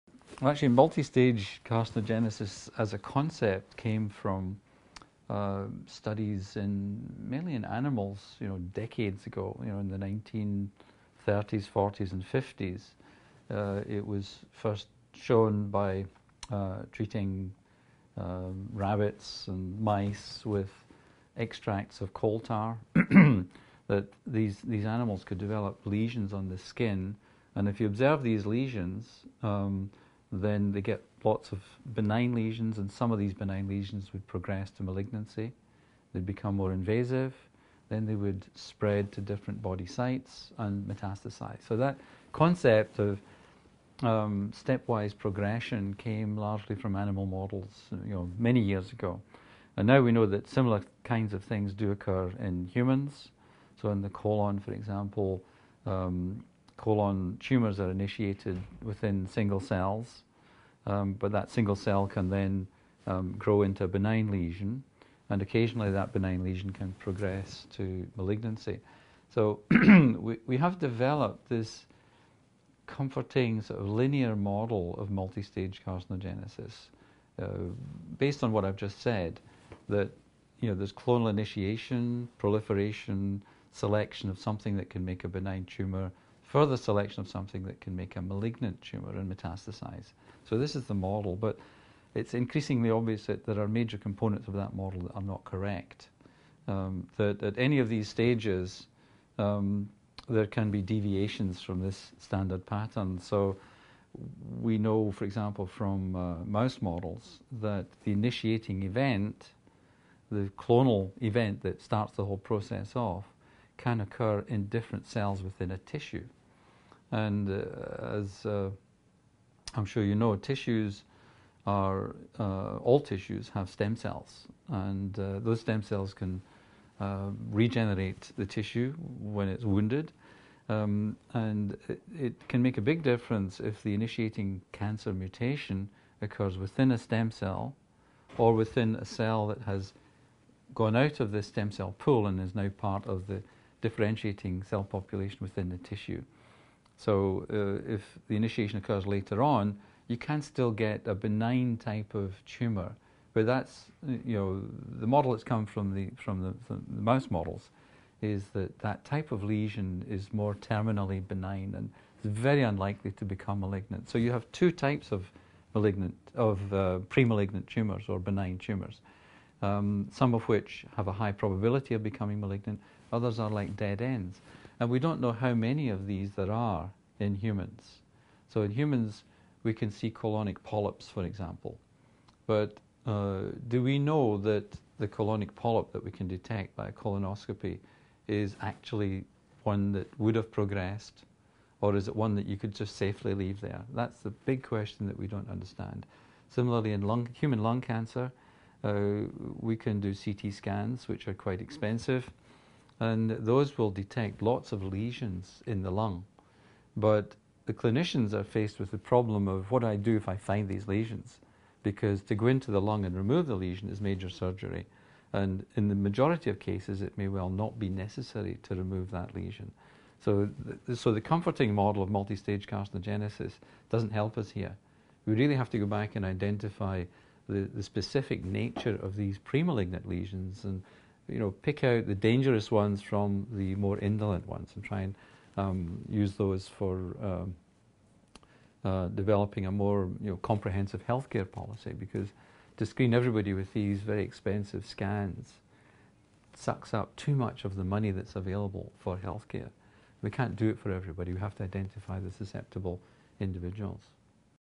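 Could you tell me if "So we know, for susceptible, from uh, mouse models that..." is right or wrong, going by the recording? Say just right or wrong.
wrong.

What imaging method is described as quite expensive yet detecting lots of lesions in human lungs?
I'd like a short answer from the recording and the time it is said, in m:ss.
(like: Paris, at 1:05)
CT scans, at 3:20.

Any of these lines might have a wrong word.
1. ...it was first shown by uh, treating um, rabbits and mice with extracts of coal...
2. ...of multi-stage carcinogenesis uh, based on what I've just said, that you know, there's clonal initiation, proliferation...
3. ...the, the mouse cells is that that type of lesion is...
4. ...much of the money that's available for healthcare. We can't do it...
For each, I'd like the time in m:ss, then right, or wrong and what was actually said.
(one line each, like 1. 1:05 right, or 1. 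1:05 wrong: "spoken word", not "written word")
1. 0:13 right
2. 1:14 right
3. 2:36 wrong: "models", not "cells"
4. 4:07 right.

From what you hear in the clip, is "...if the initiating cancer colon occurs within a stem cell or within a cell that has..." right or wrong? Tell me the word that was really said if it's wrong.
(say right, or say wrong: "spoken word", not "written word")
wrong: "mutation", not "colon".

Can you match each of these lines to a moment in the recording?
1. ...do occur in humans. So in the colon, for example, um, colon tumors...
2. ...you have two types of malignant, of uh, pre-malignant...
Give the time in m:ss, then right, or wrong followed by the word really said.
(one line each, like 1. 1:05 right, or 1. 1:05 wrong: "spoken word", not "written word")
1. 0:51 right
2. 2:44 right.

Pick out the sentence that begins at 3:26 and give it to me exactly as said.
But the clinicians are faced with the problem of what do I do if I find these lesions?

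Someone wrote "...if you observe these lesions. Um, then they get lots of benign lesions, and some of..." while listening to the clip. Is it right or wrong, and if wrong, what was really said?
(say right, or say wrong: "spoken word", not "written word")
right.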